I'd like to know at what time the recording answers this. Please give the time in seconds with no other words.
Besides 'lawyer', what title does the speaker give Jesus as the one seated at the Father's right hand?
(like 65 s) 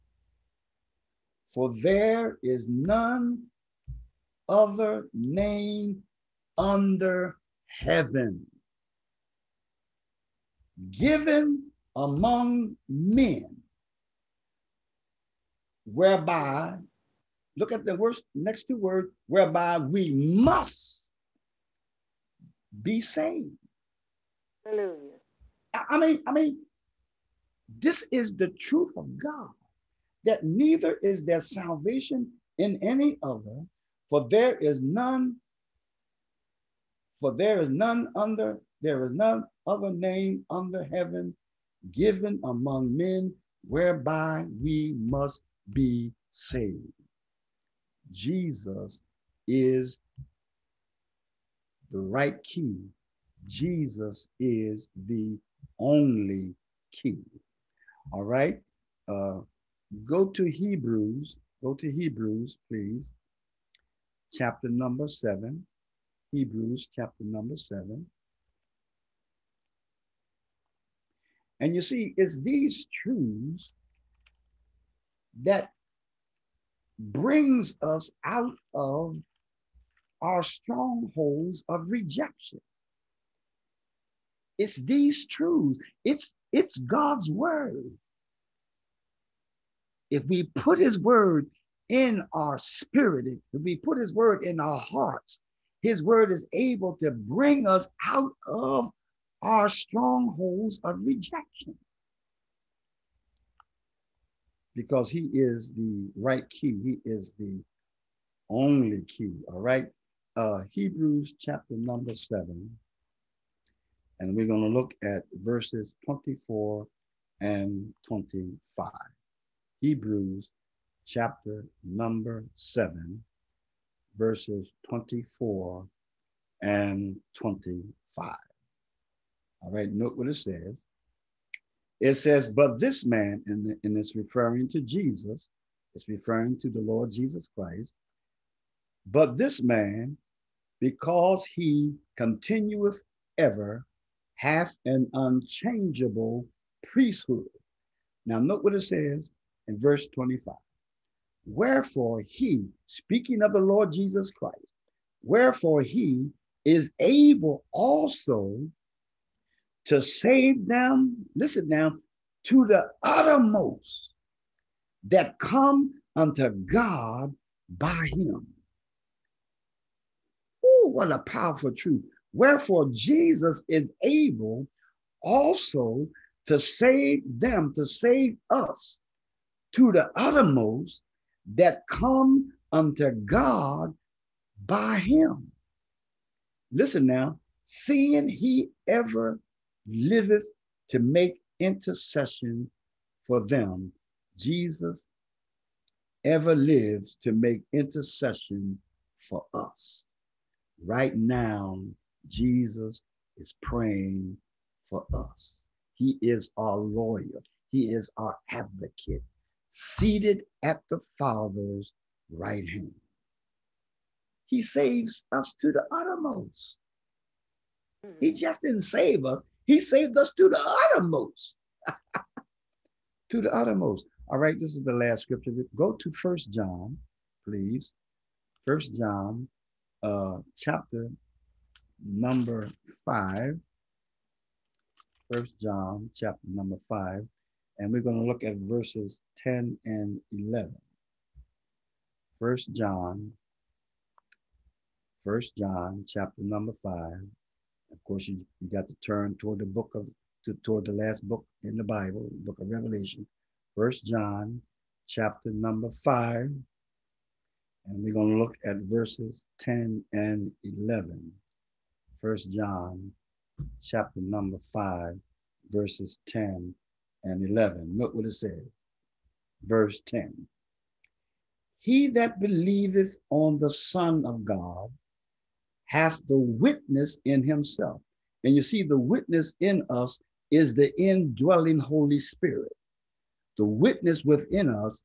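208 s.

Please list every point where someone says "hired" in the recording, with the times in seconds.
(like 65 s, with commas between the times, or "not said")
not said.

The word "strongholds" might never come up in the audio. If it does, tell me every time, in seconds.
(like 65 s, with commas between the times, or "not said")
80 s, 99 s.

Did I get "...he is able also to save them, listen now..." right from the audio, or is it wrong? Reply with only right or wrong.
right.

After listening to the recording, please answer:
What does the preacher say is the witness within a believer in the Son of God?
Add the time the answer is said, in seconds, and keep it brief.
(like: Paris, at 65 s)
the indwelling Holy Spirit, at 280 s.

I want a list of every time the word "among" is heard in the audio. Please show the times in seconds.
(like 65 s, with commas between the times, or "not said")
11 s, 42 s.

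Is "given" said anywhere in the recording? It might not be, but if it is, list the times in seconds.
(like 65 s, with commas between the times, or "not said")
10 s, 41 s.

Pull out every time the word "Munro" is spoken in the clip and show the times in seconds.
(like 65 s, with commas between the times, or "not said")
not said.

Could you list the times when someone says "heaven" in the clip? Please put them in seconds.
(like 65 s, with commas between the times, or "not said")
7 s, 40 s.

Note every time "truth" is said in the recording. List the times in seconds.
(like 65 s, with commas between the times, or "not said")
28 s, 73 s, 85 s, 171 s.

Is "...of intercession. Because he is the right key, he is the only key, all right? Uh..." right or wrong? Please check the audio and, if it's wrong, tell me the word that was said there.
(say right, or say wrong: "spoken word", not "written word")
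wrong: "rejection", not "intercession".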